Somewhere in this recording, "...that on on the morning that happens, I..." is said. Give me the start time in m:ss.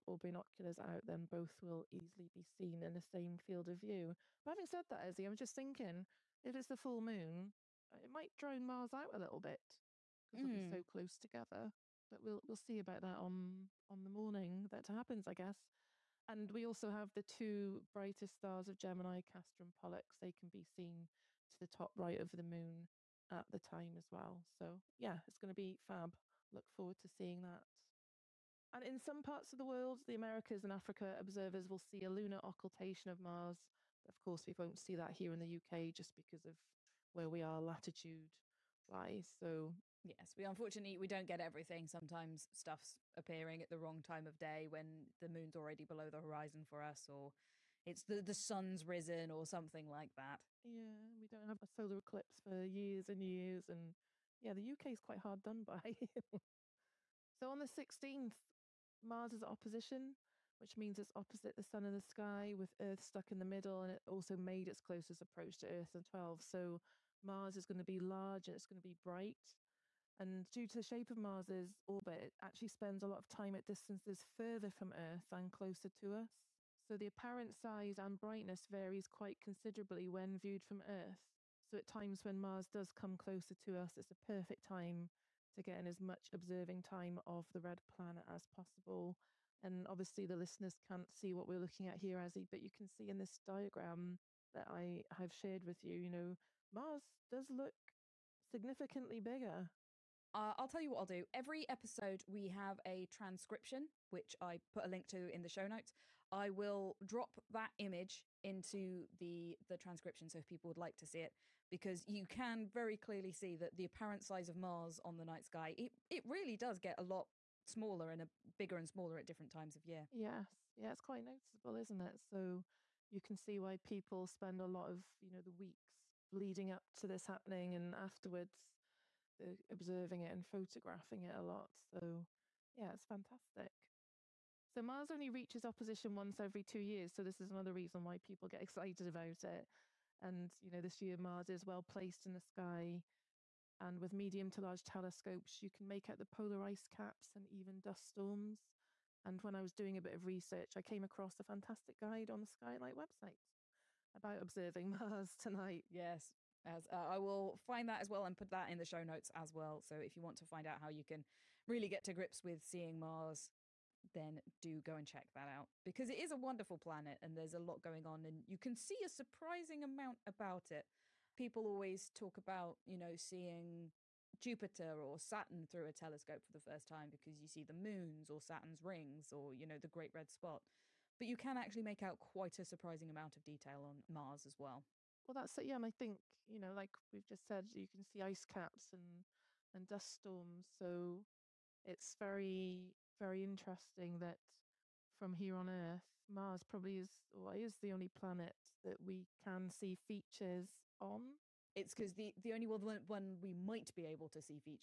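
0:13.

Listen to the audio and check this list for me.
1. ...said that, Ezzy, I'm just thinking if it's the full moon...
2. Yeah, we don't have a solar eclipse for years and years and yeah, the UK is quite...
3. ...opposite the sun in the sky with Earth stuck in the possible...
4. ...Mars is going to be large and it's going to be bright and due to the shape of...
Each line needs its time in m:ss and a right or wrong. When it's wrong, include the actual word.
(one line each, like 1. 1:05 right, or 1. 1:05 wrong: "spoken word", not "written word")
1. 0:04 right
2. 0:50 right
3. 1:01 wrong: "middle", not "possible"
4. 1:07 right.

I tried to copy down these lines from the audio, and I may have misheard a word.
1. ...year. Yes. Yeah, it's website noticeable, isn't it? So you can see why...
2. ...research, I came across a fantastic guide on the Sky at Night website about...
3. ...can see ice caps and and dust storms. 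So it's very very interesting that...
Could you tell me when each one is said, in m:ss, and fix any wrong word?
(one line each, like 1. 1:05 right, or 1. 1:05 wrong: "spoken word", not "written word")
1. 1:59 wrong: "quite", not "website"
2. 2:30 right
3. 3:07 right.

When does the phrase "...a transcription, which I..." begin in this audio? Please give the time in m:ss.
1:42.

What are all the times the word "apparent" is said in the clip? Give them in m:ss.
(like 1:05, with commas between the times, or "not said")
1:17, 1:53.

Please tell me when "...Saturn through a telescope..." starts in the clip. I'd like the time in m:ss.
2:55.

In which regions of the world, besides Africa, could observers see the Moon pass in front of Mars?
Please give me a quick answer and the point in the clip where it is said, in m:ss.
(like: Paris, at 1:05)
The Americas, at 0:30.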